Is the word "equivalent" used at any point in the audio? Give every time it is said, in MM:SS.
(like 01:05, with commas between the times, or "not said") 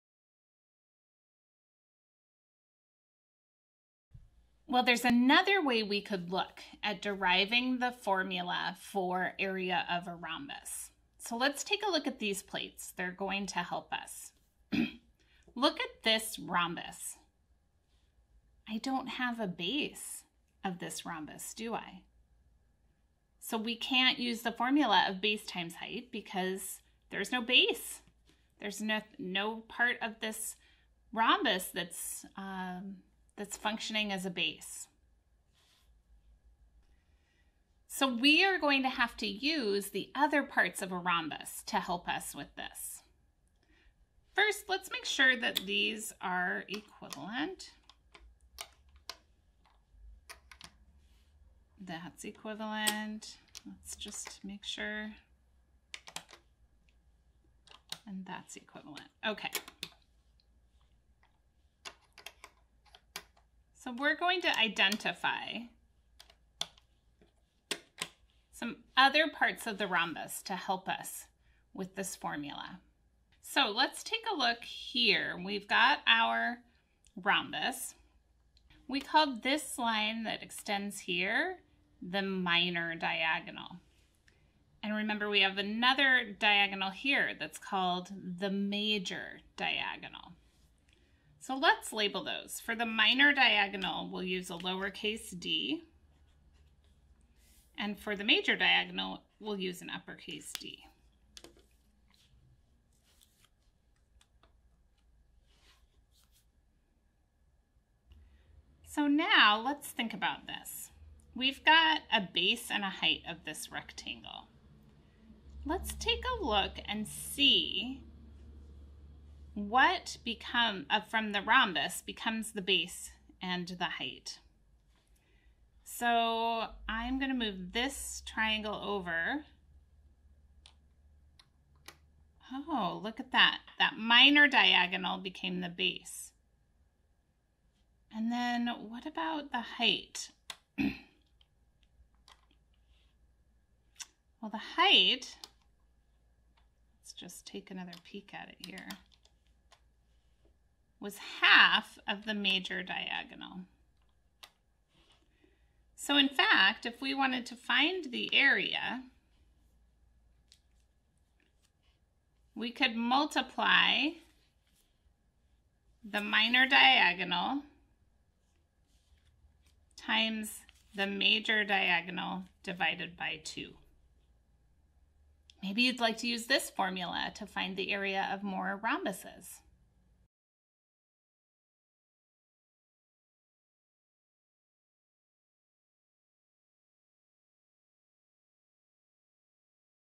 00:46, 00:52, 00:58.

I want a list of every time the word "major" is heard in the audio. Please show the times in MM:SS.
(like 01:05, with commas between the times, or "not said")
01:28, 01:38, 02:32, 02:51.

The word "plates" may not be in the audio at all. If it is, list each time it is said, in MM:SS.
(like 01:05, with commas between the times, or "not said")
00:12.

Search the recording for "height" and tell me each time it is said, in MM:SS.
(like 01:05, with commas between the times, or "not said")
00:25, 01:52, 02:03, 02:19, 02:24.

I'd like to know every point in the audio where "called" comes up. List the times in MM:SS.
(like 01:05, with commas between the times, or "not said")
01:19, 01:27.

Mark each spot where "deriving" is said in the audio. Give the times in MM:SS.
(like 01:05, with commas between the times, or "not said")
00:07.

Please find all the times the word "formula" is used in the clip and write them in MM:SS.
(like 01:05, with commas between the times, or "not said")
00:07, 00:24, 01:12, 02:56.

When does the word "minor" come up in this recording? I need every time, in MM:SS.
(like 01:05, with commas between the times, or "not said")
01:22, 01:32, 02:13, 02:46.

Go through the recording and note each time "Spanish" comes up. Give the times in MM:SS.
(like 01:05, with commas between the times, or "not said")
not said.